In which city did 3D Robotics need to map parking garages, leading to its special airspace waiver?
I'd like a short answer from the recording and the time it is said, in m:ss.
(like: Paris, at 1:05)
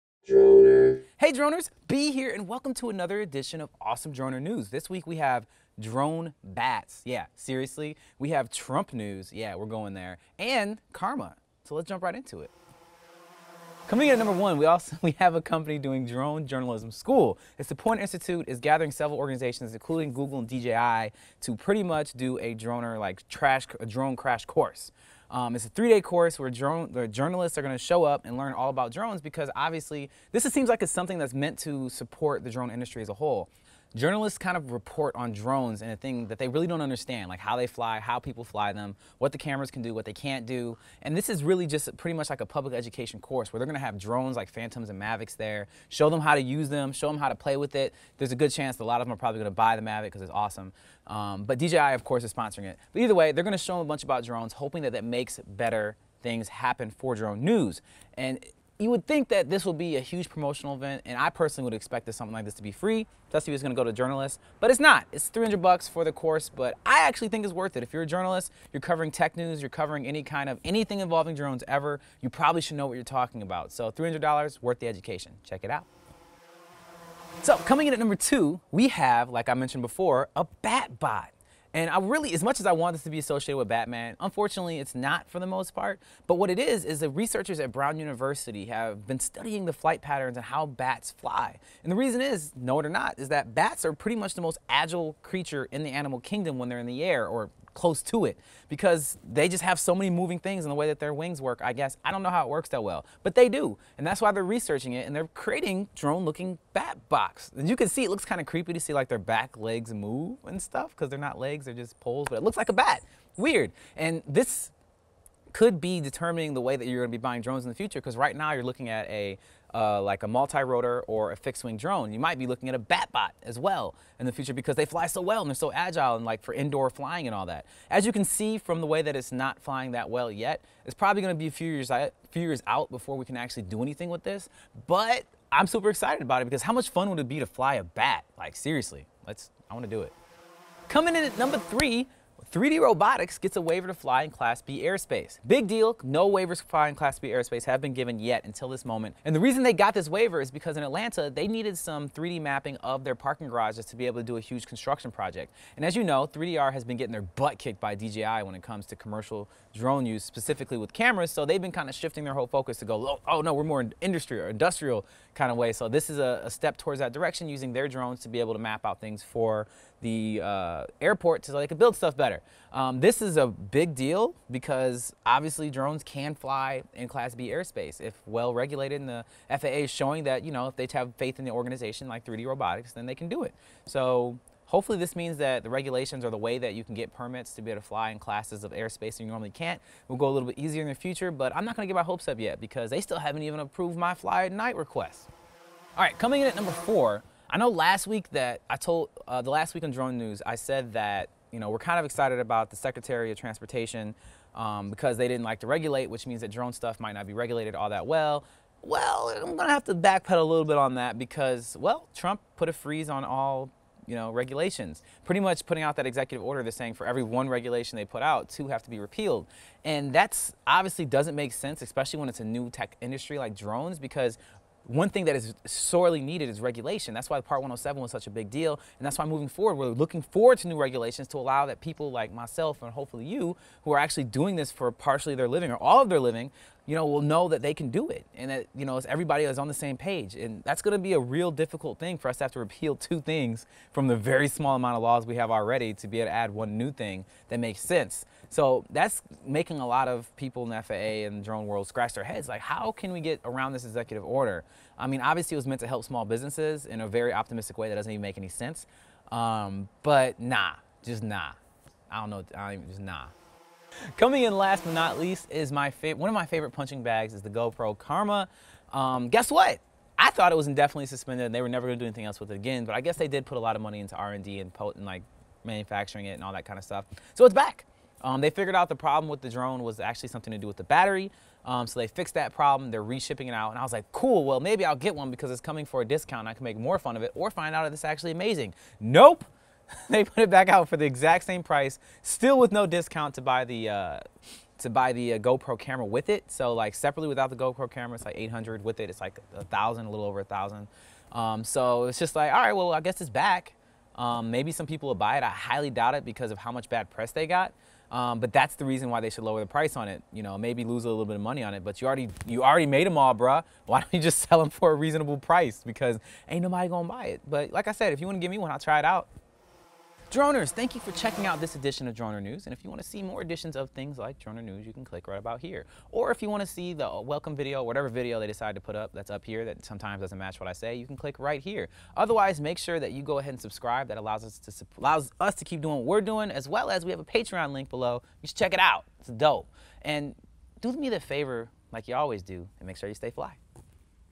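Atlanta, at 2:30.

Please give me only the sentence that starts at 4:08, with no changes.
So that's making a lot of people in the FAA and the drone world scratch their heads.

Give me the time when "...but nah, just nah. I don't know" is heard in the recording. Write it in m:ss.
4:20.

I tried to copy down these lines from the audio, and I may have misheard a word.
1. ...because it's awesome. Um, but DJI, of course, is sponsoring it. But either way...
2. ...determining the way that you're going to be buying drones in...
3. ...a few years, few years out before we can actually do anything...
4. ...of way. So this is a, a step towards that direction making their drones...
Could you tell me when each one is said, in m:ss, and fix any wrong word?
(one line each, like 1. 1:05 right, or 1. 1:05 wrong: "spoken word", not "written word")
1. 0:50 right
2. 1:56 right
3. 2:11 right
4. 2:45 wrong: "using", not "making".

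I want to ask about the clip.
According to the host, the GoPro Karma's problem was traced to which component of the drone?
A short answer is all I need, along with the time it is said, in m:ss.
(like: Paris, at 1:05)
The battery, at 4:40.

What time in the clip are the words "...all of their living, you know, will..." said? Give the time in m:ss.
3:55.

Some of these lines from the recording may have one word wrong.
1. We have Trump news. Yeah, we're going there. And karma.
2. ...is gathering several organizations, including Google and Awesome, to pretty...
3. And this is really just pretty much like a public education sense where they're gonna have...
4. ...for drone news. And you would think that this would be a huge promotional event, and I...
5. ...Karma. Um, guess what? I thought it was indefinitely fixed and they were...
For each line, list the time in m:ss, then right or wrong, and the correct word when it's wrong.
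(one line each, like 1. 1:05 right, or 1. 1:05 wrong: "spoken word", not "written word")
1. 0:08 right
2. 0:18 wrong: "DJI", not "Awesome"
3. 0:41 wrong: "course", not "sense"
4. 0:56 right
5. 4:27 wrong: "suspended", not "fixed".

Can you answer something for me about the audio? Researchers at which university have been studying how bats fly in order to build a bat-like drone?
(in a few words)
Brown University.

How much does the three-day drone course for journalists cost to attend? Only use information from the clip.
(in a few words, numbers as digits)
$300.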